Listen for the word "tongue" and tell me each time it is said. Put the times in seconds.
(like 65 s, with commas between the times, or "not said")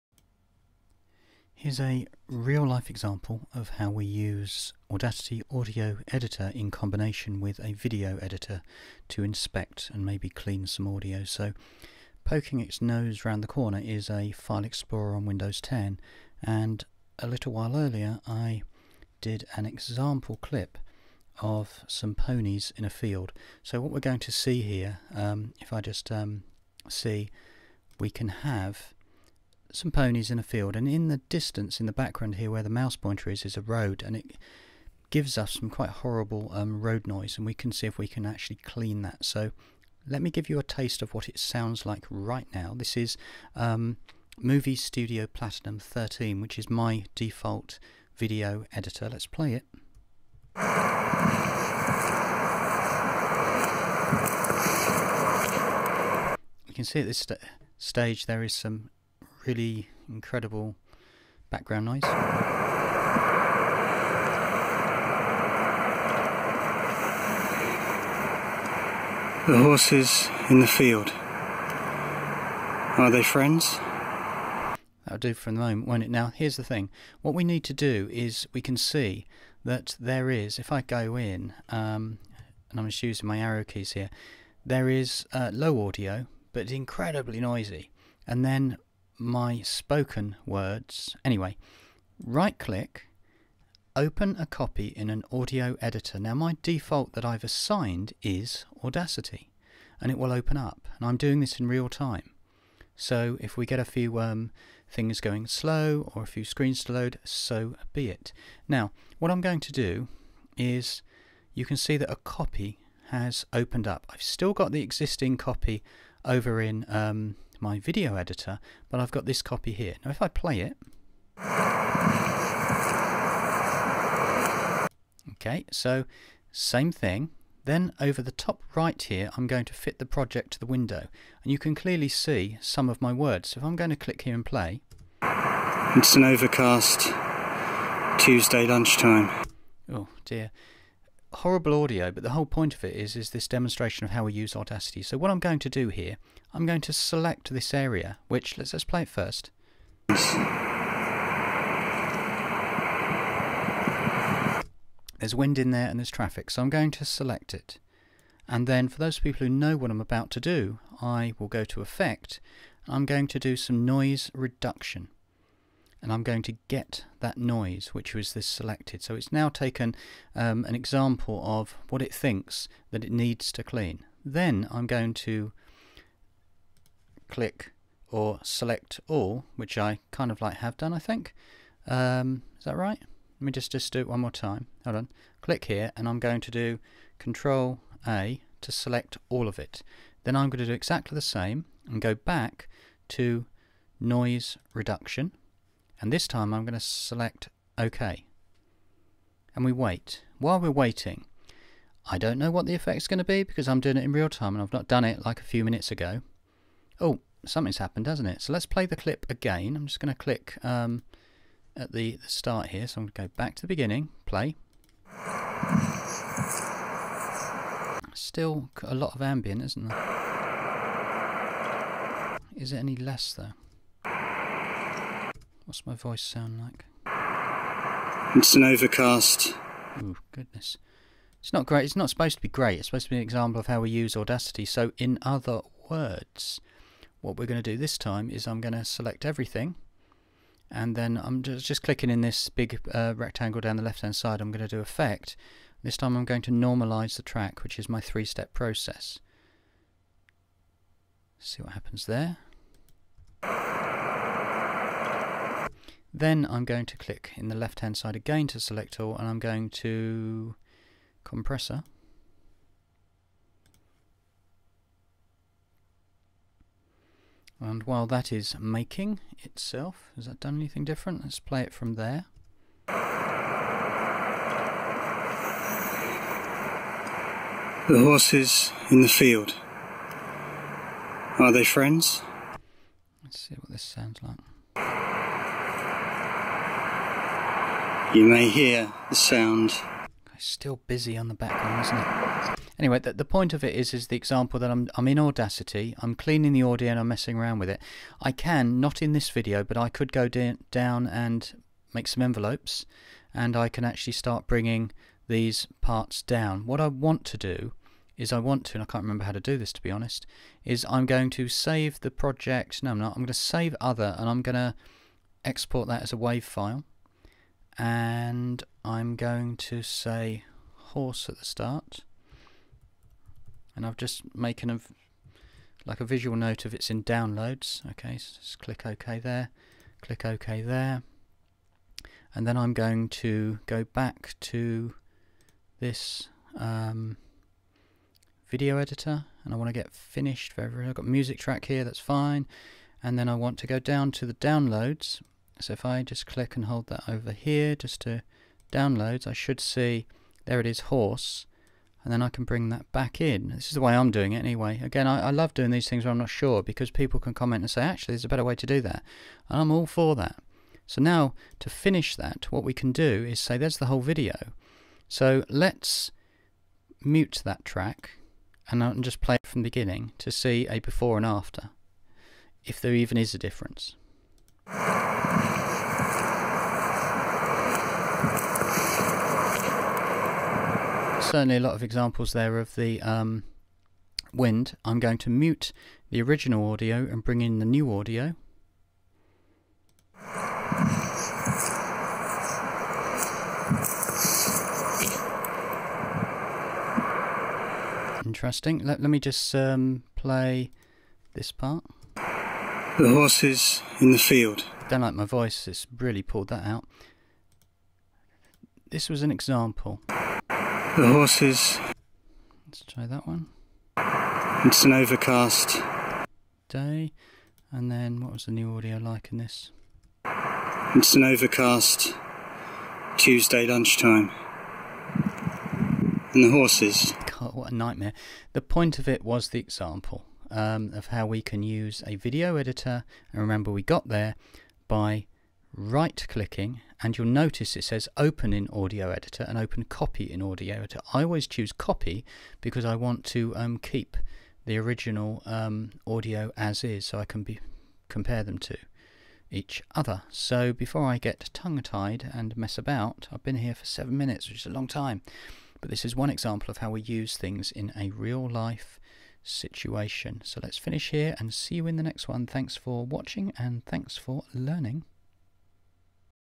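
451 s.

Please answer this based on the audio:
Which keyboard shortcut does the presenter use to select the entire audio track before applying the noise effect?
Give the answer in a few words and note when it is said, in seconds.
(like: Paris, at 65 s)
Control A, at 187 s.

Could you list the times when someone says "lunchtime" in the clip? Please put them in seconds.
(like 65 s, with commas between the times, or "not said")
138 s, 423 s.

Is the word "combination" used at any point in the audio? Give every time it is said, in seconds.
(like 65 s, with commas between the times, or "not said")
6 s.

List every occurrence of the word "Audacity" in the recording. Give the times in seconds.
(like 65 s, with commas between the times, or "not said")
4 s, 98 s, 144 s, 234 s, 295 s.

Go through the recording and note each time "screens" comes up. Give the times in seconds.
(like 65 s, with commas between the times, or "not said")
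106 s.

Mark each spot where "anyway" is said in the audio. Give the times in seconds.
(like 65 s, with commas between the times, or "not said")
91 s, 292 s, 354 s.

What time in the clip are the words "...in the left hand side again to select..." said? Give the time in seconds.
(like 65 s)
257 s.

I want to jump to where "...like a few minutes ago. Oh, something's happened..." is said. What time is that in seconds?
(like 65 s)
205 s.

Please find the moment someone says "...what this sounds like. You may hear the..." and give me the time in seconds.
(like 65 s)
283 s.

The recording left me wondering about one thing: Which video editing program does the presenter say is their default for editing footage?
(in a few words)
Movie Studio Platinum 13.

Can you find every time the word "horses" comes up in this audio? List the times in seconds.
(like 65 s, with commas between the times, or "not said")
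69 s, 277 s, 320 s, 350 s, 403 s, 411 s, 426 s.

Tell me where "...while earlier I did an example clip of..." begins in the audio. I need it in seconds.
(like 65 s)
17 s.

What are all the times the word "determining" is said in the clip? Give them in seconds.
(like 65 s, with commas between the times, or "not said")
not said.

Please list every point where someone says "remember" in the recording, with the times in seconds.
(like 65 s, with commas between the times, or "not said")
309 s, 433 s.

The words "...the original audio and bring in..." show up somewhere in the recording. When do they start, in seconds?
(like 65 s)
386 s.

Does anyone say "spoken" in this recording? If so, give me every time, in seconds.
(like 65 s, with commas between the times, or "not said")
89 s.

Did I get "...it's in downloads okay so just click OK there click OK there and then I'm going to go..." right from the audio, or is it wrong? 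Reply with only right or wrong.
right.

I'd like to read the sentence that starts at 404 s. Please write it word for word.
Don't like my voice, it's really pulled that out.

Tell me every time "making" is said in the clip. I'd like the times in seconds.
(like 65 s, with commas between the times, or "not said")
268 s, 324 s.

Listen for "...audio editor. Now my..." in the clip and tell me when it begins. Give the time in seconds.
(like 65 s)
95 s.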